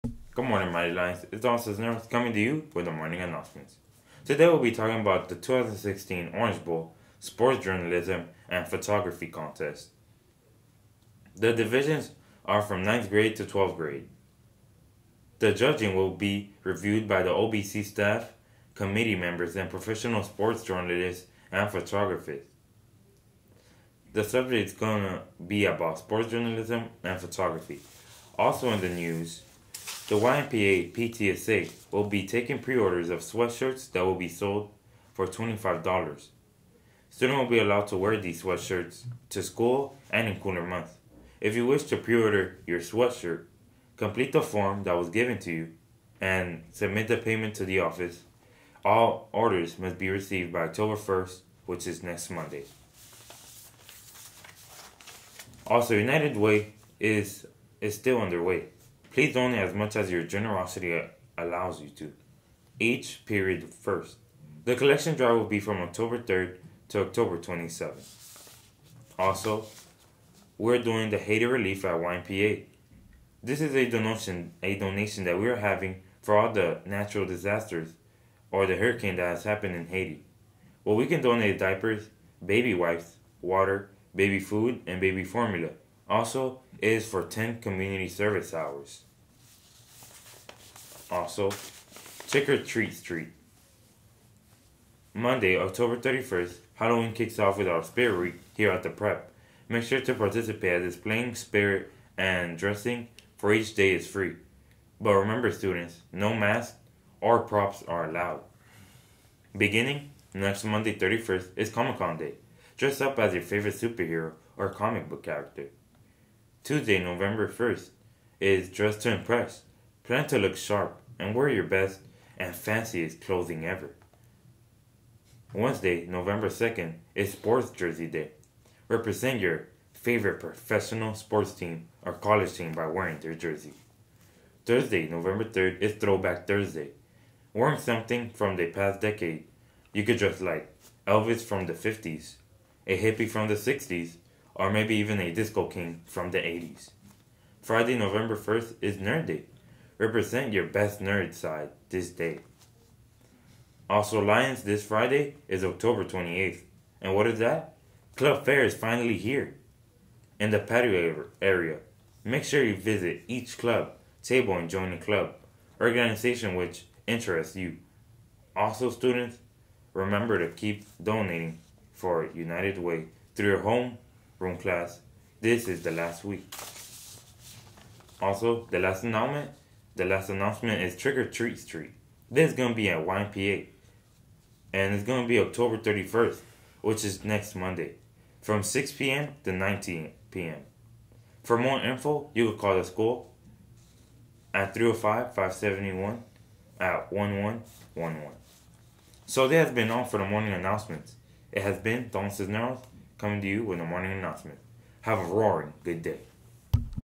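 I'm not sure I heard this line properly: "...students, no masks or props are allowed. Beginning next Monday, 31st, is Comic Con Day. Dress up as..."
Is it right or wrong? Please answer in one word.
right.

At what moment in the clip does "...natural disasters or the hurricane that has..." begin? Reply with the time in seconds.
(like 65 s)
76 s.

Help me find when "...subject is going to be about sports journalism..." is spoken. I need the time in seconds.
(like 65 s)
24 s.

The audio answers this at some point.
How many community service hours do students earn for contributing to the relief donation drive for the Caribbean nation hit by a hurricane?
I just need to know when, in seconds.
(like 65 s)
87 s.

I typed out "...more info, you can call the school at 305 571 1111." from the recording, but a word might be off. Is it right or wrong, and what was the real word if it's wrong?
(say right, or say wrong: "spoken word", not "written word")
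right.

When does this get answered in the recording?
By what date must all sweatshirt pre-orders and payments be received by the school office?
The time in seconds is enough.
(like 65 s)
50 s.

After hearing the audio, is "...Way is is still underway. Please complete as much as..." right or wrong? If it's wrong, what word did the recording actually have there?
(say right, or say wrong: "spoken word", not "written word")
wrong: "donate", not "complete".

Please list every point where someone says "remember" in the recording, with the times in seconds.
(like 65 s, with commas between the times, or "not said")
105 s, 169 s.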